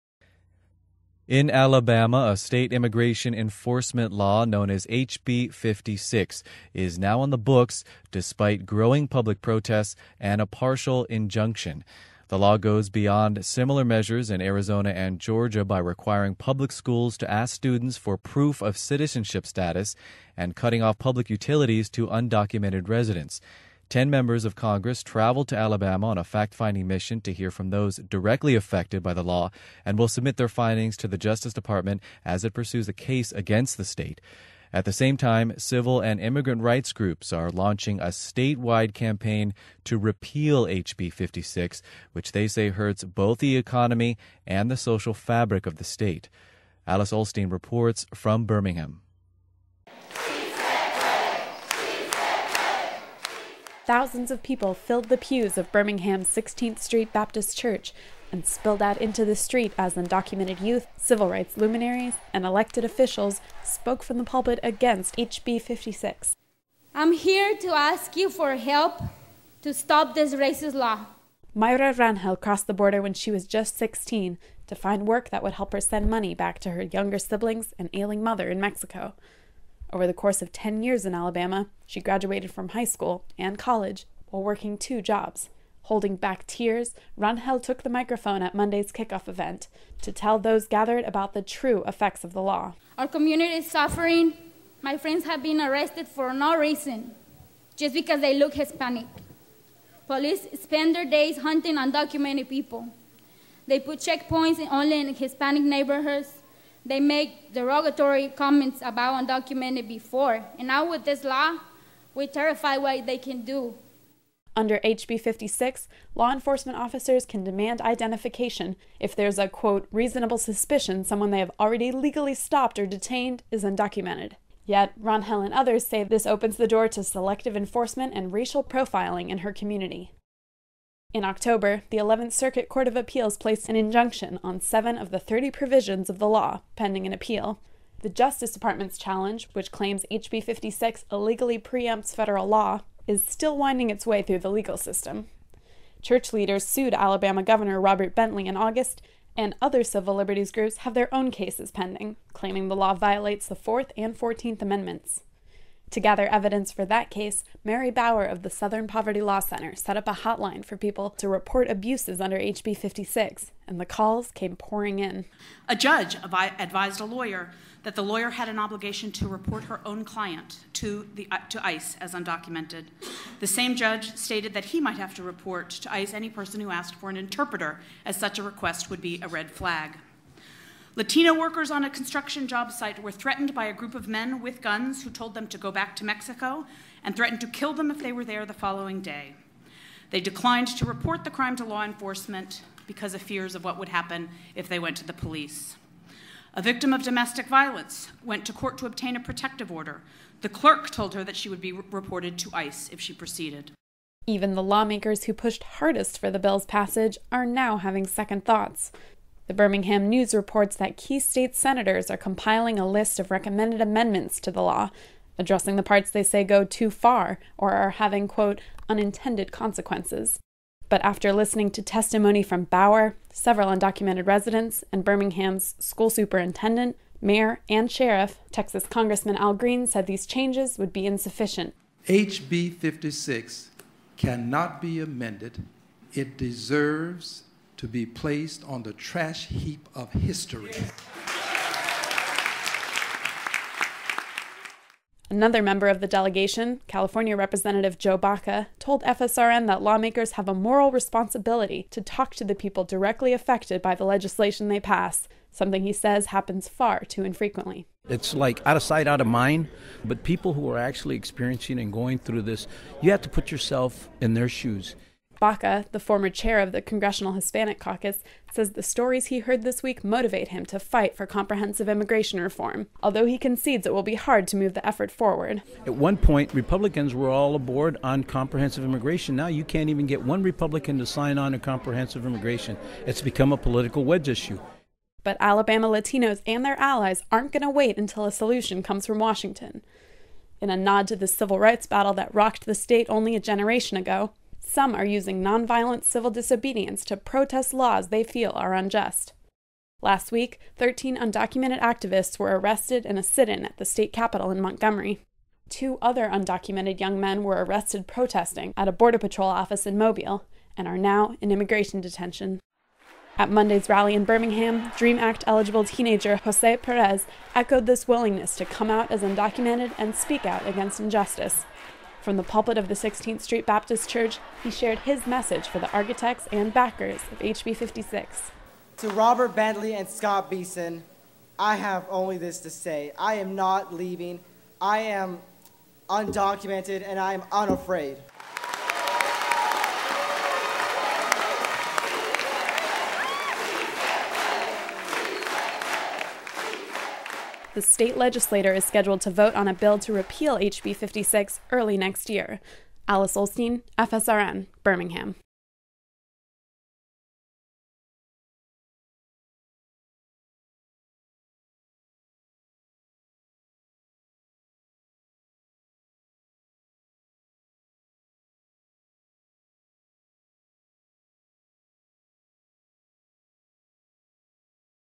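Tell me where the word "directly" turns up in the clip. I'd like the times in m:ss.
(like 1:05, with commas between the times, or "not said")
0:27, 4:12.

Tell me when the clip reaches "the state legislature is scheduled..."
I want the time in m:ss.
5:47.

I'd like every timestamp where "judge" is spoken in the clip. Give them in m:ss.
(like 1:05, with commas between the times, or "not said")
2:45, 2:53.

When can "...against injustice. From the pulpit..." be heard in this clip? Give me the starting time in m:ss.
5:20.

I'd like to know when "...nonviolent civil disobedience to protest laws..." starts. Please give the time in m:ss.
4:55.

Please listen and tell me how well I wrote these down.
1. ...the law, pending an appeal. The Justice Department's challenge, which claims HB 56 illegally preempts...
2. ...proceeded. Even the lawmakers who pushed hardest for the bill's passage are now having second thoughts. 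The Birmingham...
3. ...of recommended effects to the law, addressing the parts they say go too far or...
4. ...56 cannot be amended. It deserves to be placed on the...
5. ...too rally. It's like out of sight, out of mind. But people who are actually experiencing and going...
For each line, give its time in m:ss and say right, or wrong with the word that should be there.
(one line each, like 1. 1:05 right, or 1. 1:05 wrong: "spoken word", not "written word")
1. 2:16 right
2. 3:23 right
3. 3:33 wrong: "amendments", not "effects"
4. 3:52 right
5. 4:17 wrong: "infrequently", not "rally".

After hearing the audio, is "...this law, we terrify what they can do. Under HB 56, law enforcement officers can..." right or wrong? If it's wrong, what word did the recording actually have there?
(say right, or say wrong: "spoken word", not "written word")
right.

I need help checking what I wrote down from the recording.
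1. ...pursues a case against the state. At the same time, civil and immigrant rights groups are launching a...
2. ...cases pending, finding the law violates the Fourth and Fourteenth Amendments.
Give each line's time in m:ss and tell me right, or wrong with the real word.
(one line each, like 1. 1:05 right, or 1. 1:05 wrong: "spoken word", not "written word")
1. 0:32 right
2. 2:31 wrong: "claiming", not "finding".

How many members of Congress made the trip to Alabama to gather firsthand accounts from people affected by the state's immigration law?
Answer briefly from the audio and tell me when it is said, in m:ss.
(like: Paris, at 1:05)
10, at 0:23.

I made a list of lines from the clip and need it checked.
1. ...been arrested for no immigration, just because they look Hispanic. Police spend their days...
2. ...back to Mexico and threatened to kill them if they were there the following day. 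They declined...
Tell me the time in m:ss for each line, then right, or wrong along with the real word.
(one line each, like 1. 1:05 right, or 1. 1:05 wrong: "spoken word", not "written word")
1. 1:35 wrong: "reason", not "immigration"
2. 3:05 right.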